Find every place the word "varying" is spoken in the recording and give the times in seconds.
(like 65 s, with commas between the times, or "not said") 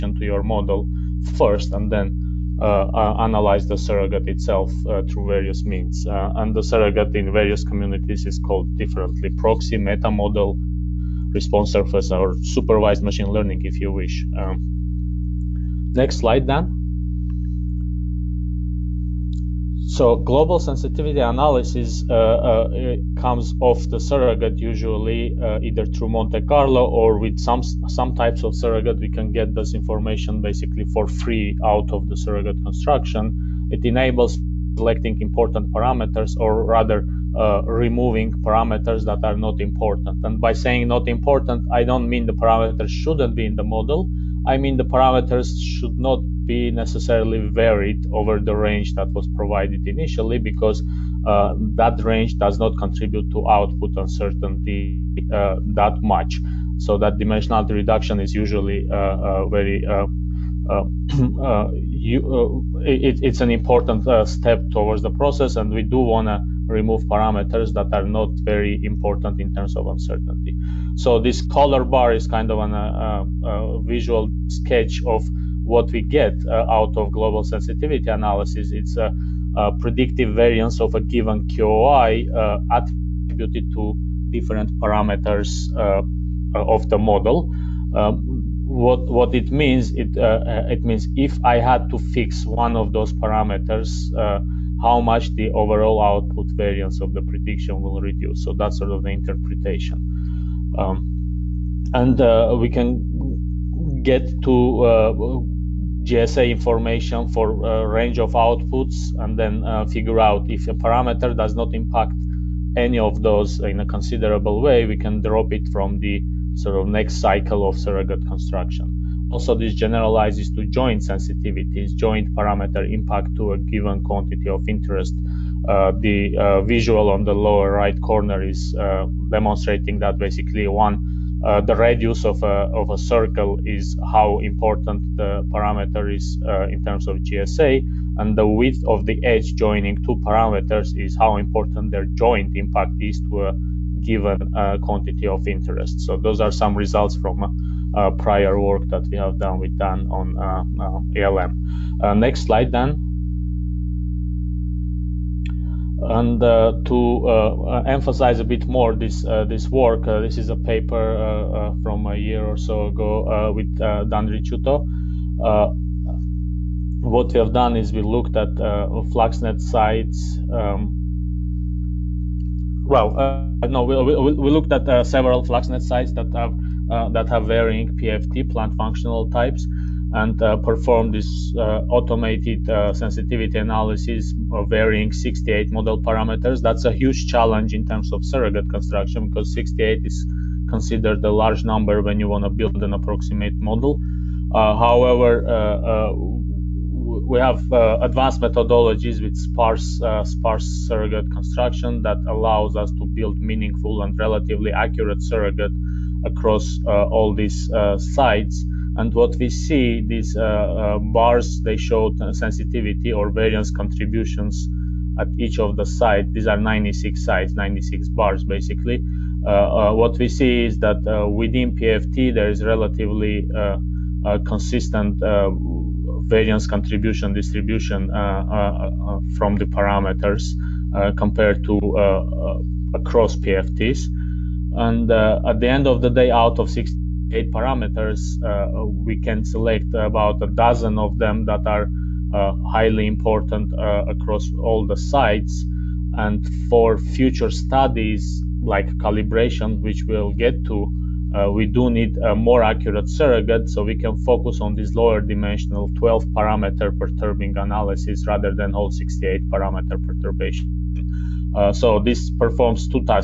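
177 s, 184 s.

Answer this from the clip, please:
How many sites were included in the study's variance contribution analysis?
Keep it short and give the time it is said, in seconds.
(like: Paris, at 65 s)
96, at 216 s.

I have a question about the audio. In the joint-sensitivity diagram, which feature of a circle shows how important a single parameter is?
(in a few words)
The radius.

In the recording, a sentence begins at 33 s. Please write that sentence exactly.
It enables selecting important parameters or rather uh, removing parameters that are not important.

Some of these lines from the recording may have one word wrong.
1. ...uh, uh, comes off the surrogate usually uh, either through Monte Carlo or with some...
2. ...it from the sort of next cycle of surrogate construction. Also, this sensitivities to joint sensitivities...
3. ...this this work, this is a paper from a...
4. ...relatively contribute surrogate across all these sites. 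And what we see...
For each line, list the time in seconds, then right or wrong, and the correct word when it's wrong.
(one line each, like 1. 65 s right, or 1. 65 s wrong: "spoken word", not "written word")
1. 22 s right
2. 115 s wrong: "generalizes", not "sensitivities"
3. 158 s right
4. 204 s wrong: "accurate", not "contribute".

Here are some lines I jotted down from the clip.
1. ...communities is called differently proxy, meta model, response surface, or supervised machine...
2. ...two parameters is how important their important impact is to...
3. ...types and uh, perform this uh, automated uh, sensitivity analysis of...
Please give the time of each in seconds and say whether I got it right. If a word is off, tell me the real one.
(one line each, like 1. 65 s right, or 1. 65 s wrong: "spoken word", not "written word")
1. 7 s right
2. 139 s wrong: "joint", not "important"
3. 179 s right.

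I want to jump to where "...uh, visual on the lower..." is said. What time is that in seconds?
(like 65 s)
126 s.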